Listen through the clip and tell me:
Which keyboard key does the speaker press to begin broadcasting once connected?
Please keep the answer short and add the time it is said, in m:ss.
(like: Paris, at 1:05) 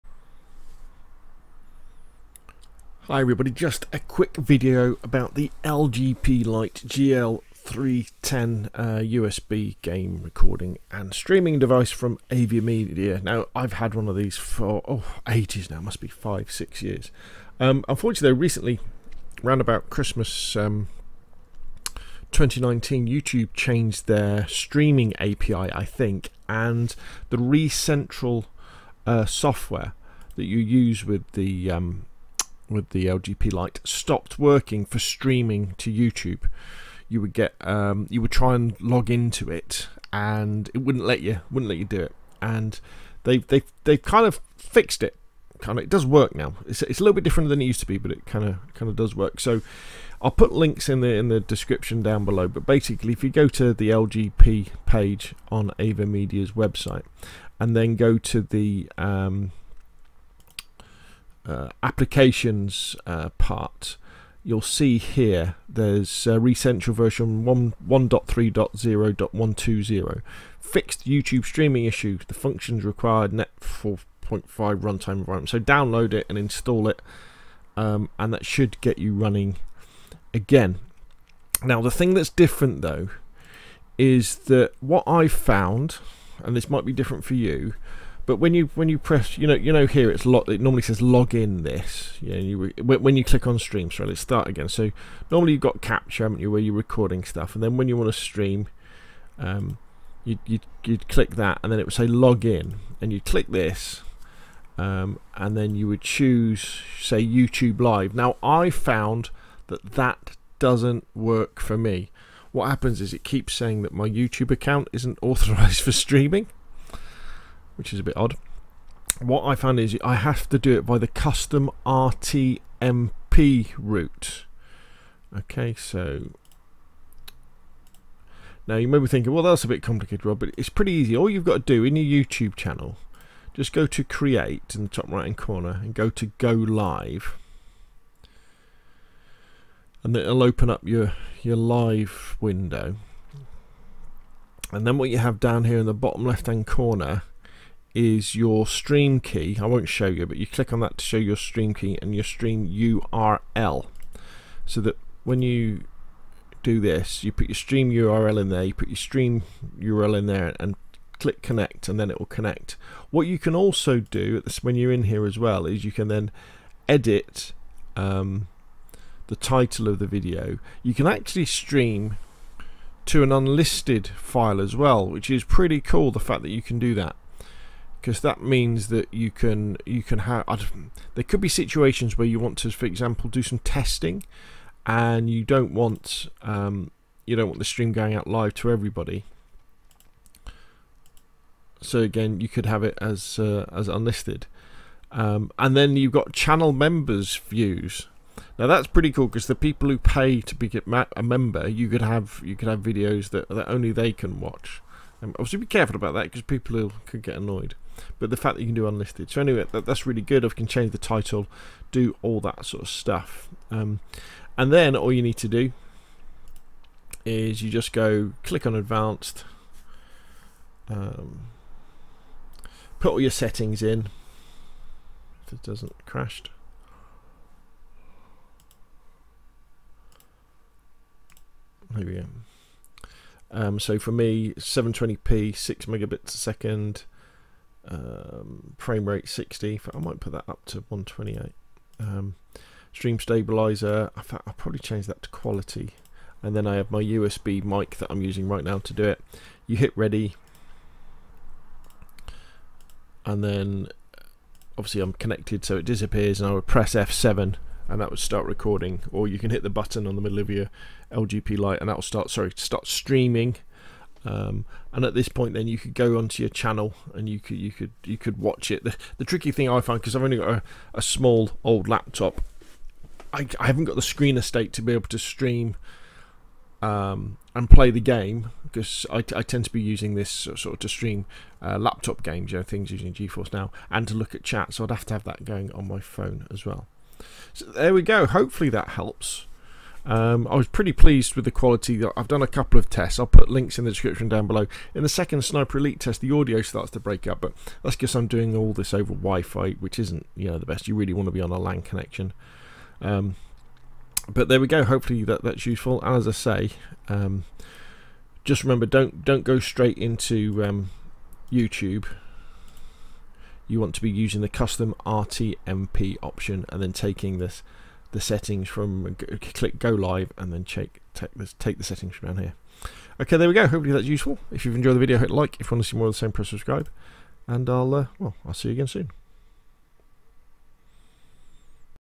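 F7, at 4:16.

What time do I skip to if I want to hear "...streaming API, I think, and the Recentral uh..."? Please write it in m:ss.
0:24.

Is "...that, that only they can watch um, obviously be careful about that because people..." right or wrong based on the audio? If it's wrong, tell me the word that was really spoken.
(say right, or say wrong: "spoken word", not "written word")
right.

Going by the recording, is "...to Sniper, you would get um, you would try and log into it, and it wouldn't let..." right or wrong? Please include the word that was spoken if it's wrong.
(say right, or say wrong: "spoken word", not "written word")
wrong: "YouTube", not "Sniper".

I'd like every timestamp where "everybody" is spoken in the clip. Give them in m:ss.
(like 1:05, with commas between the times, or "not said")
0:03, 3:08.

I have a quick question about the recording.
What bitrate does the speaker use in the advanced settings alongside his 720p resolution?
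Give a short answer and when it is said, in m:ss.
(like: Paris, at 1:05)
6 megabits a second, at 3:55.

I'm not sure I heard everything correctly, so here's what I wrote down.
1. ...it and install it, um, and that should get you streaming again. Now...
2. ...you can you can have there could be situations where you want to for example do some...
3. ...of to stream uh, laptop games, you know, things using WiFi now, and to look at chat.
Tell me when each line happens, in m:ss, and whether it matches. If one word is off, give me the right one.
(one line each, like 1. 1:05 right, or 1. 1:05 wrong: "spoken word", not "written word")
1. 1:16 wrong: "running", not "streaming"
2. 2:59 right
3. 4:40 wrong: "GeForce", not "WiFi".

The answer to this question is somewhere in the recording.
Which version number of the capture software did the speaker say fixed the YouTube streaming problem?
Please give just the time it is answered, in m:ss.
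1:07.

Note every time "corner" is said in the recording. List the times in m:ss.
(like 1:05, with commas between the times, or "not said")
2:15, 2:26.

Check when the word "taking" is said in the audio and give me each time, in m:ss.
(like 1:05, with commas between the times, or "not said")
5:16.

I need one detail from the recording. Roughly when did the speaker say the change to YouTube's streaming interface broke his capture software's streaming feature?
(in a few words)
Christmas 2019.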